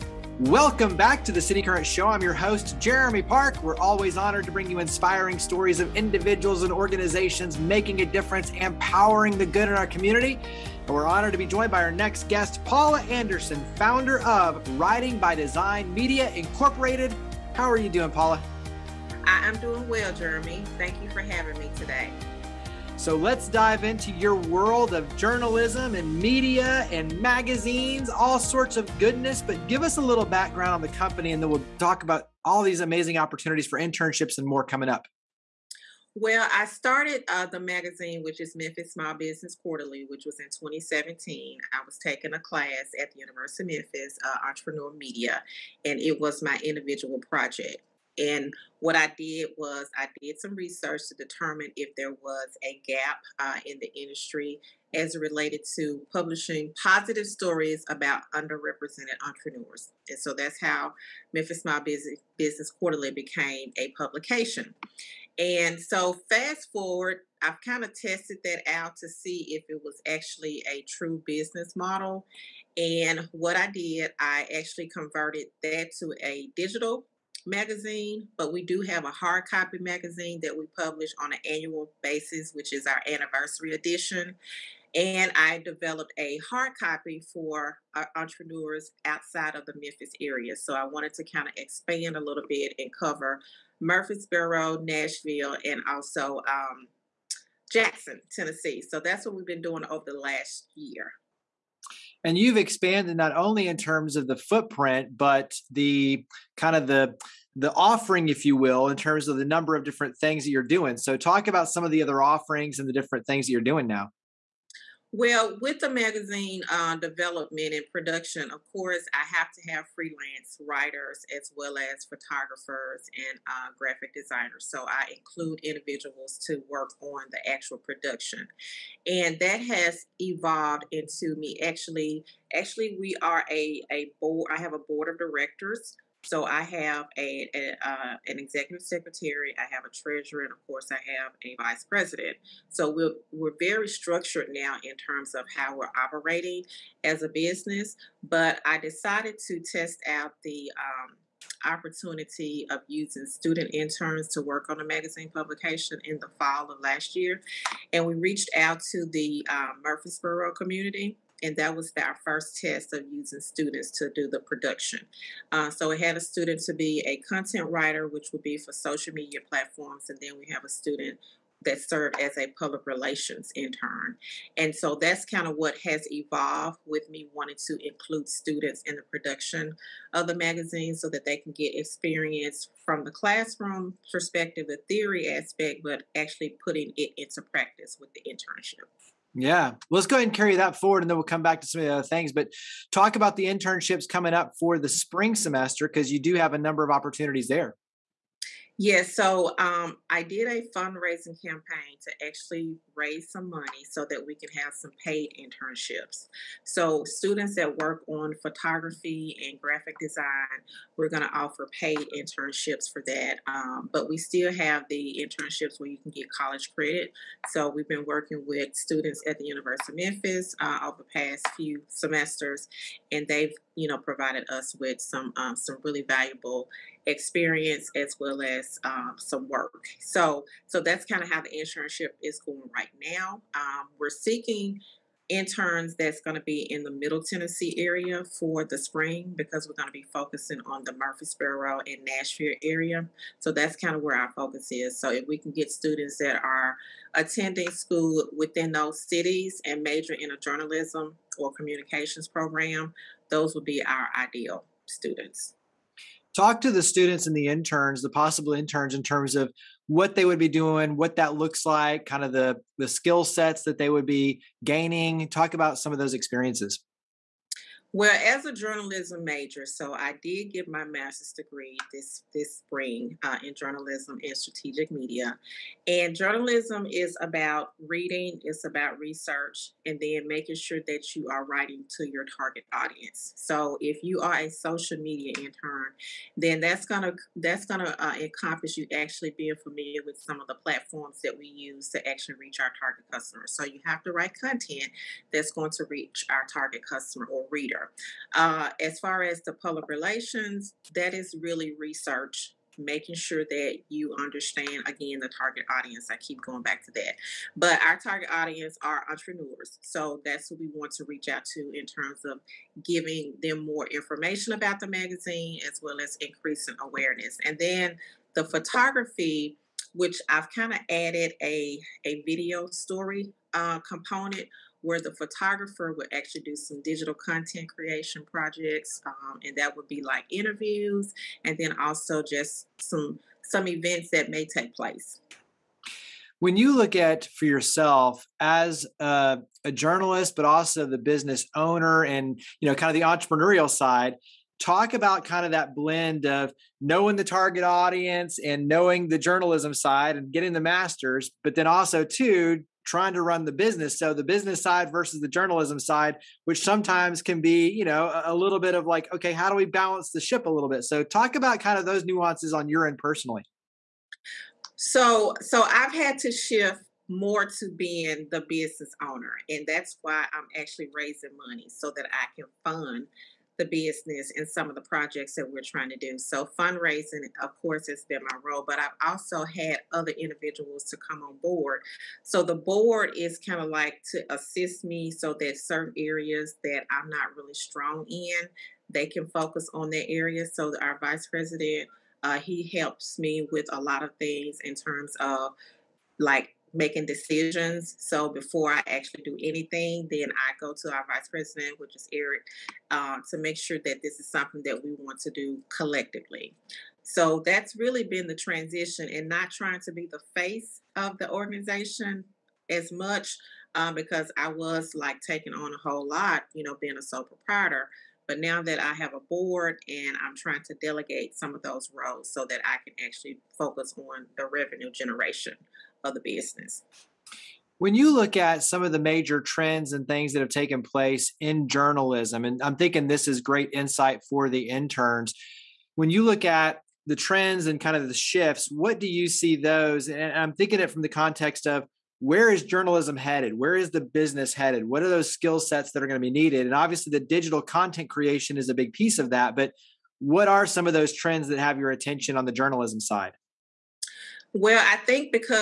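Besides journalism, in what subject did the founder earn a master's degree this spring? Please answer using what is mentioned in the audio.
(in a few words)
strategic media.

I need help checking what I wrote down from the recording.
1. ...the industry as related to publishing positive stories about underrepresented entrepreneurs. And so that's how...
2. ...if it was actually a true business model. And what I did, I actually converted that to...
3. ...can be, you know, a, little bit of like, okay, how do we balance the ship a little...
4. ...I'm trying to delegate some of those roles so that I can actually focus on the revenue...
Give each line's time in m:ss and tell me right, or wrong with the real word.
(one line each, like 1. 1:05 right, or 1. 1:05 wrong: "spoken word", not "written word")
1. 0:53 right
2. 1:09 right
3. 5:57 right
4. 7:00 right.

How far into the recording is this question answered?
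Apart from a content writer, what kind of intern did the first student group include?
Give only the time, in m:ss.
2:52.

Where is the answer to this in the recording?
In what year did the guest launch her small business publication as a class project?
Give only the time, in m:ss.
0:40.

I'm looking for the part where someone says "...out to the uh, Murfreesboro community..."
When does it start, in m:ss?
2:38.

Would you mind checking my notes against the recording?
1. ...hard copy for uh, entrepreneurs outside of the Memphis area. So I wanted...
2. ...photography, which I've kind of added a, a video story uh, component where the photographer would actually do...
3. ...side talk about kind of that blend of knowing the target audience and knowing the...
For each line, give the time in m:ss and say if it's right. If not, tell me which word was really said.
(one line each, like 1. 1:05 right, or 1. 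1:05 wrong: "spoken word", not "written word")
1. 1:26 right
2. 5:18 right
3. 5:43 right.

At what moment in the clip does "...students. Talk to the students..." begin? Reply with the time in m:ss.
4:14.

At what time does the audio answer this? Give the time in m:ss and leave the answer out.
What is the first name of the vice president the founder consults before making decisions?
6:42.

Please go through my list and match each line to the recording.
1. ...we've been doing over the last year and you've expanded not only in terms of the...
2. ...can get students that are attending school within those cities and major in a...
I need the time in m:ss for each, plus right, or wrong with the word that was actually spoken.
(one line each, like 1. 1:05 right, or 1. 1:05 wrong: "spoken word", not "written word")
1. 1:39 right
2. 4:05 right.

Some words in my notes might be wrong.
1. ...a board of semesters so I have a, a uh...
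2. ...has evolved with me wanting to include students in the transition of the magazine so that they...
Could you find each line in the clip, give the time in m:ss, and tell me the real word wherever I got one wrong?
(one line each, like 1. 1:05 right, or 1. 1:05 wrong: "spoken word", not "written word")
1. 2:14 wrong: "directors", not "semesters"
2. 2:55 wrong: "production", not "transition".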